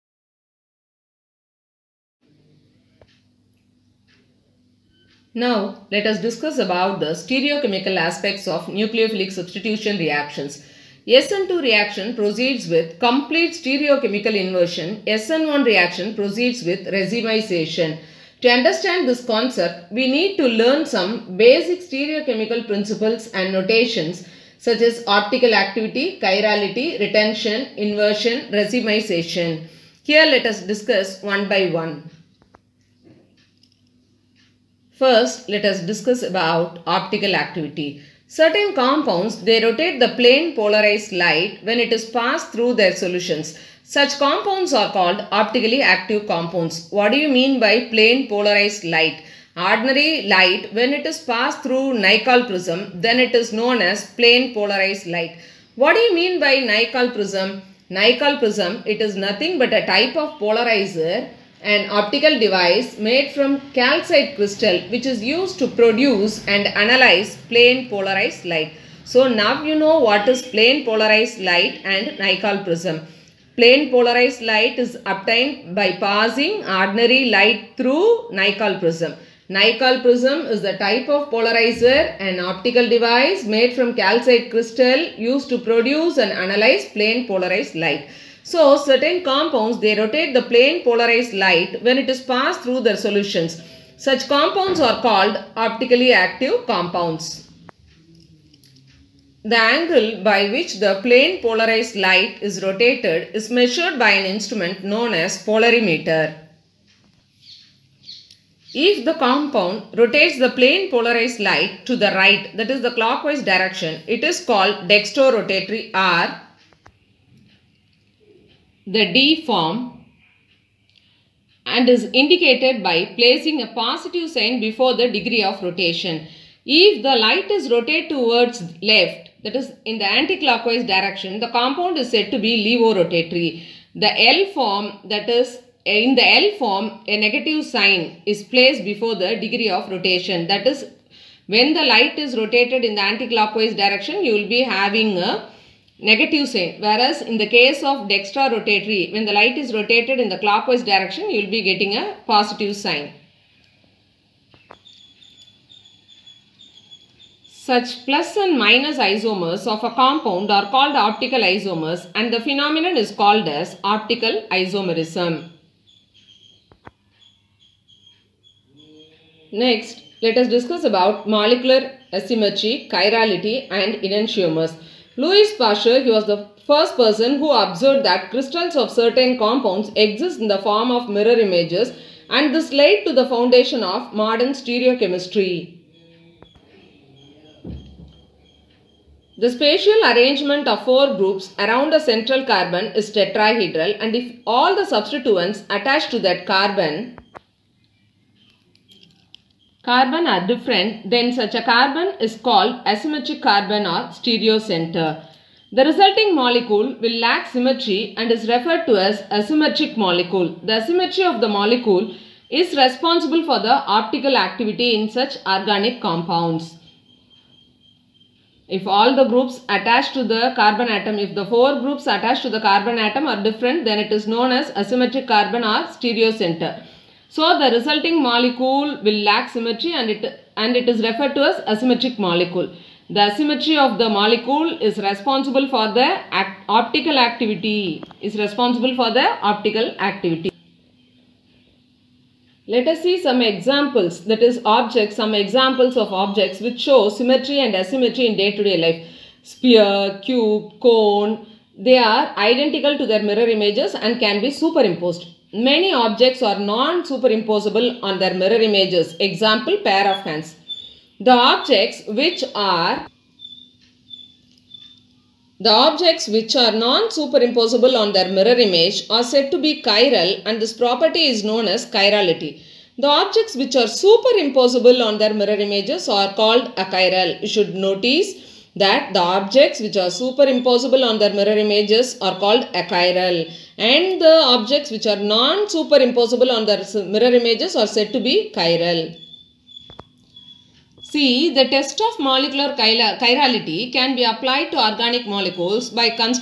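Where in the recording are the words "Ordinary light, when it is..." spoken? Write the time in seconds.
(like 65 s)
49 s.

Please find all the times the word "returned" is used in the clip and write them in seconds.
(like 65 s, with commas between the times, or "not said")
not said.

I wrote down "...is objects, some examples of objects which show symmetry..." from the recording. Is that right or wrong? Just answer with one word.
right.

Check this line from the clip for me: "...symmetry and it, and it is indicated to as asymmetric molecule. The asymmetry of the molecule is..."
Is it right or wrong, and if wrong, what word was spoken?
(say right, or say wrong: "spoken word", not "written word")
wrong: "referred", not "indicated".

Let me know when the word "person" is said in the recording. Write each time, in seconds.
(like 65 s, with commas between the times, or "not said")
176 s.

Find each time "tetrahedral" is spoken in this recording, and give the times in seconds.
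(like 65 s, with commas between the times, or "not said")
193 s.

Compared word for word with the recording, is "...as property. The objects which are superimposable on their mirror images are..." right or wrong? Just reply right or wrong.
wrong.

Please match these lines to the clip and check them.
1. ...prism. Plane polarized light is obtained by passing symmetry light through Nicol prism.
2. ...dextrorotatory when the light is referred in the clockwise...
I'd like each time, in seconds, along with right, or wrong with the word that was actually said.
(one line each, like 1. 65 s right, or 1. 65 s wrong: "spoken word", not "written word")
1. 72 s wrong: "ordinary", not "symmetry"
2. 148 s wrong: "rotated", not "referred".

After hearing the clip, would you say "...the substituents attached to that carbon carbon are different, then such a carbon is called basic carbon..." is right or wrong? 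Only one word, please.
wrong.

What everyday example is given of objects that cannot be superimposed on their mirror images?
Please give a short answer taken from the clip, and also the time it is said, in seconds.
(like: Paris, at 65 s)
pair of hands, at 259 s.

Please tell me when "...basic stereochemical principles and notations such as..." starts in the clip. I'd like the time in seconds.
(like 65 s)
21 s.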